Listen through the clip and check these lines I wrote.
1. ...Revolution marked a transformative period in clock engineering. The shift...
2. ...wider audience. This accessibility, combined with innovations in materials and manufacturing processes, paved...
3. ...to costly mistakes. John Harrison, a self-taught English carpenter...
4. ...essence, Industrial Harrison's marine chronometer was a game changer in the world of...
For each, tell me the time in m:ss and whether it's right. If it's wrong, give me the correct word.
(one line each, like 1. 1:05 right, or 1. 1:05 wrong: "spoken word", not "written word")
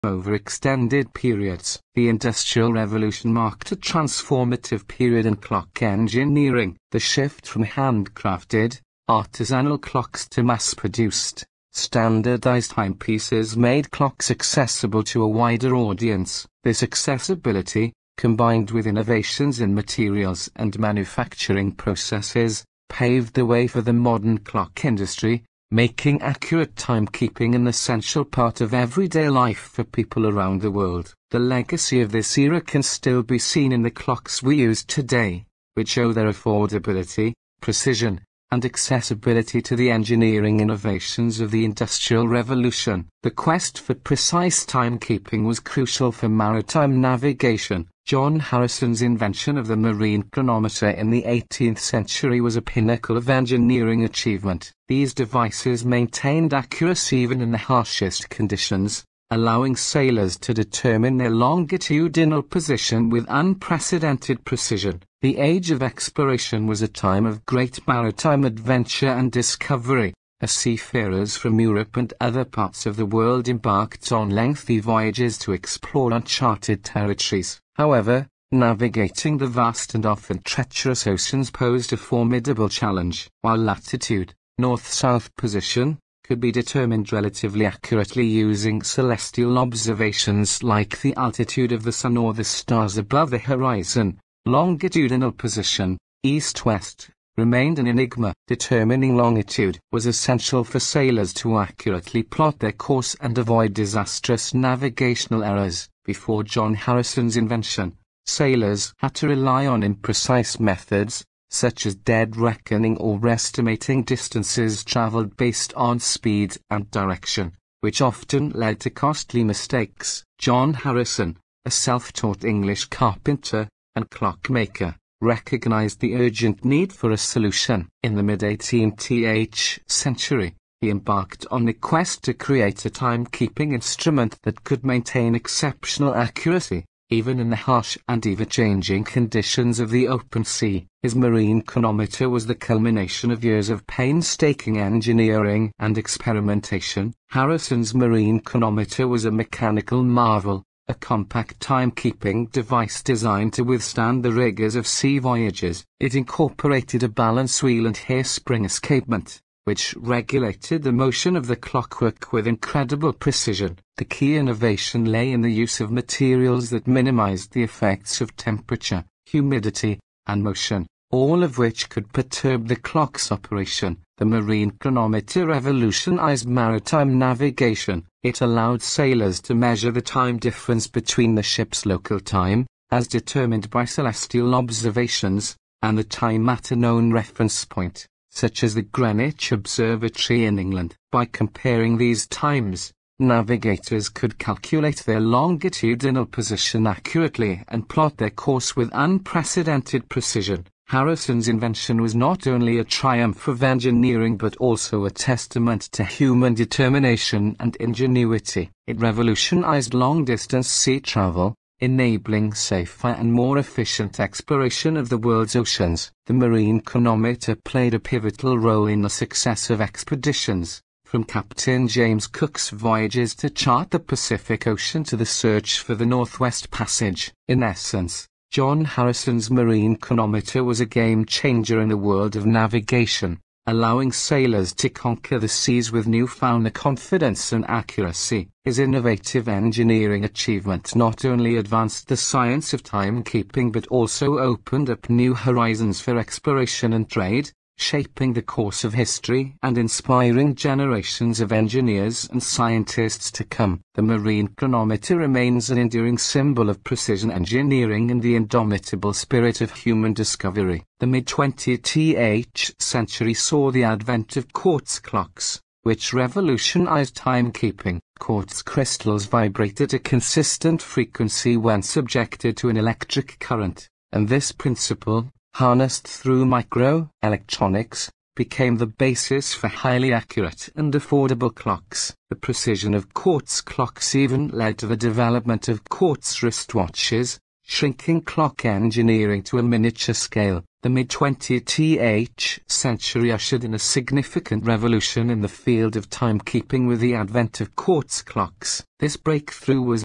1. 0:02 right
2. 0:15 right
3. 1:58 right
4. 3:47 wrong: "John", not "Industrial".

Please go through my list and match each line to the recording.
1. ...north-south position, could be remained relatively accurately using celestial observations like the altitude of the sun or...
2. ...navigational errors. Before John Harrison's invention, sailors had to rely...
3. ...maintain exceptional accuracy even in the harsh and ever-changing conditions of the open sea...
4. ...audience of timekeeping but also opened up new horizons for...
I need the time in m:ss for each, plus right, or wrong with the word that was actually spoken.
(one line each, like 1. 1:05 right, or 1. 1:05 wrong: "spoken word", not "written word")
1. 1:24 wrong: "determined", not "remained"
2. 1:44 right
3. 2:14 right
4. 4:02 wrong: "science", not "audience".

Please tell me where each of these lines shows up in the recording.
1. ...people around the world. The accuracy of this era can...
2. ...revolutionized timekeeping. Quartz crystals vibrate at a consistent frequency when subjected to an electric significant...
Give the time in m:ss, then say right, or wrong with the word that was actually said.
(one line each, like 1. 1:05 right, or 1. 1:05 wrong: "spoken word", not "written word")
1. 0:29 wrong: "legacy", not "accuracy"
2. 4:26 wrong: "current", not "significant".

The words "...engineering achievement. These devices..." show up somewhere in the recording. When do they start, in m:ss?
0:53.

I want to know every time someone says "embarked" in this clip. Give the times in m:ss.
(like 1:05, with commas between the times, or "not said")
1:13, 2:10.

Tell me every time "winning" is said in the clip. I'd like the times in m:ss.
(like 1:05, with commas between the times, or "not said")
not said.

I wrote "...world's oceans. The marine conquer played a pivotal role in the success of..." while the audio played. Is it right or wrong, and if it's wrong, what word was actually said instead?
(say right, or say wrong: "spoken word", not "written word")
wrong: "chronometer", not "conquer".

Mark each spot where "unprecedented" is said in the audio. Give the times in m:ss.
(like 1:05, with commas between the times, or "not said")
1:03, 3:18.